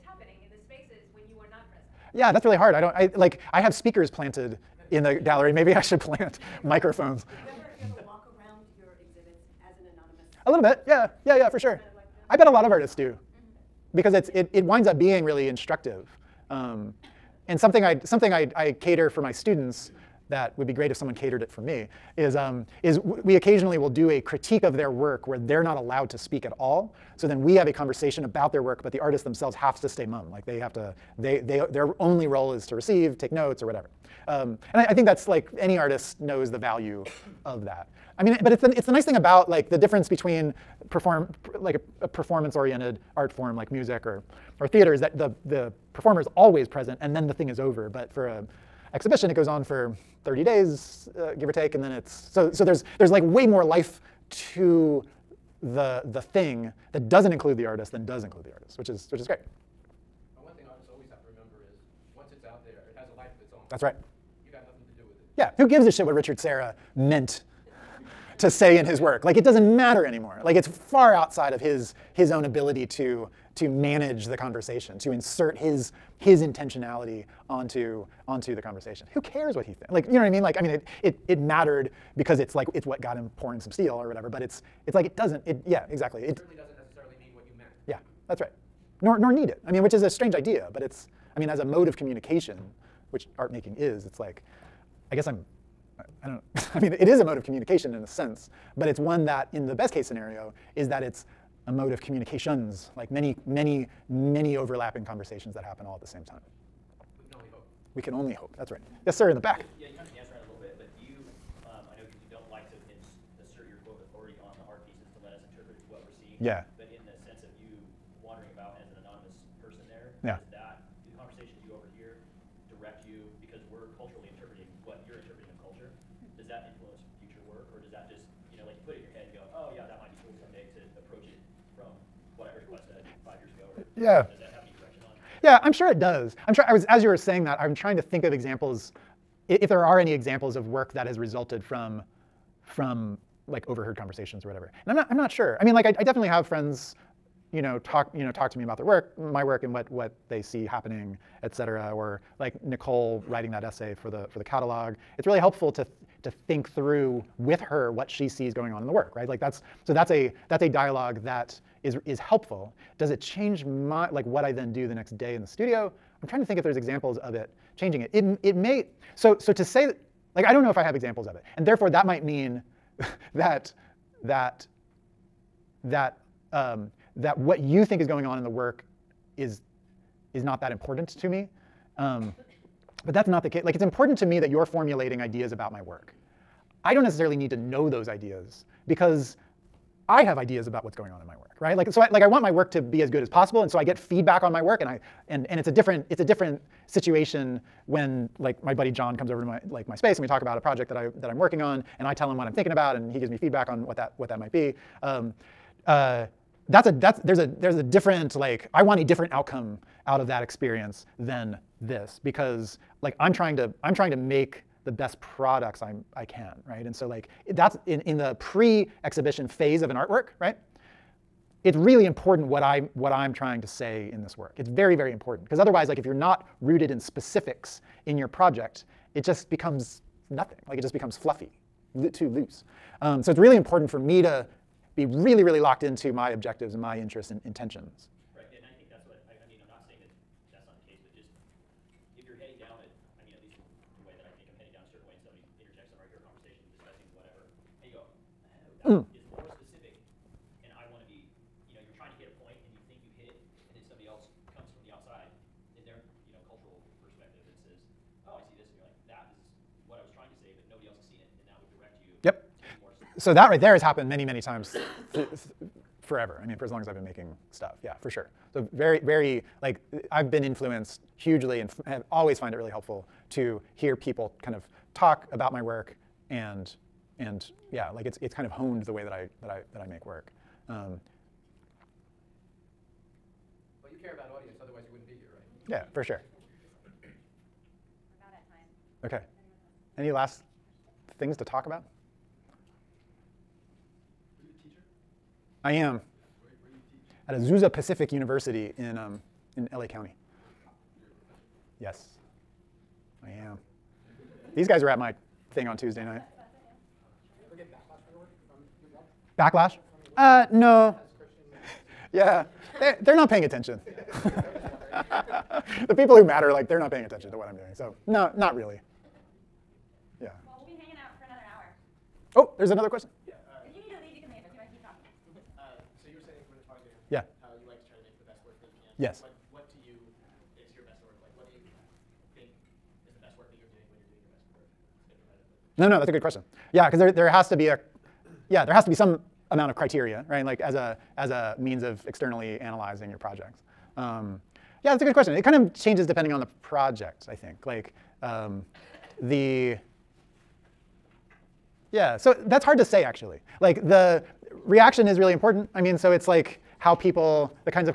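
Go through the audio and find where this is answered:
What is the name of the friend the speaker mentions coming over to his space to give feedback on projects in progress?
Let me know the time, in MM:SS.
03:18.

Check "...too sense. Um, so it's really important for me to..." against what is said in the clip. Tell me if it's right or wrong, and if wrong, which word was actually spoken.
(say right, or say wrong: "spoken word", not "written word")
wrong: "loose", not "sense".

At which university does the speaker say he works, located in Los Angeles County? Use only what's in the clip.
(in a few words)
Azusa Pacific University.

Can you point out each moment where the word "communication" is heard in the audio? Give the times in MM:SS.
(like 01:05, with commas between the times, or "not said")
01:31, 01:37, 01:42.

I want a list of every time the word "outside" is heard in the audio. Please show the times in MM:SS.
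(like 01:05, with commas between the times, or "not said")
01:11, 04:14.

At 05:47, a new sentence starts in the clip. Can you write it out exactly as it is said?
Like um, the, yeah, so that's hard to say actually.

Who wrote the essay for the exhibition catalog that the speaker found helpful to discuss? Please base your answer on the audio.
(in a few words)
Nicole.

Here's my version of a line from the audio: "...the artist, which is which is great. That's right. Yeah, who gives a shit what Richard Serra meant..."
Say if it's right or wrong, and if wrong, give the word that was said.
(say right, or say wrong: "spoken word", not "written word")
right.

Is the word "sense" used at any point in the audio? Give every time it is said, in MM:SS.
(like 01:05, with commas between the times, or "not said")
01:38, 01:57.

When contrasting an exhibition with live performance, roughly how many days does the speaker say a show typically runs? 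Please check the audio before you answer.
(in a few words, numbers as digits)
30.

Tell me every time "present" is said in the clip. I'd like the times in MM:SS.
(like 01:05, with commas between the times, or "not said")
00:01, 00:46.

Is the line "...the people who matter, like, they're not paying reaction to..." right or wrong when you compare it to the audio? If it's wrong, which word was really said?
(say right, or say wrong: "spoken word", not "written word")
wrong: "attention", not "reaction".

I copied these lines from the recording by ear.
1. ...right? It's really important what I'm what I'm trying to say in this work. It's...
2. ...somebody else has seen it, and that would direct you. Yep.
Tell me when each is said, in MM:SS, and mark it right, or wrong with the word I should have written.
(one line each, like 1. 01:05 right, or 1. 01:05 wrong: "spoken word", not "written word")
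1. 03:40 right
2. 04:20 wrong: "nobody", not "somebody".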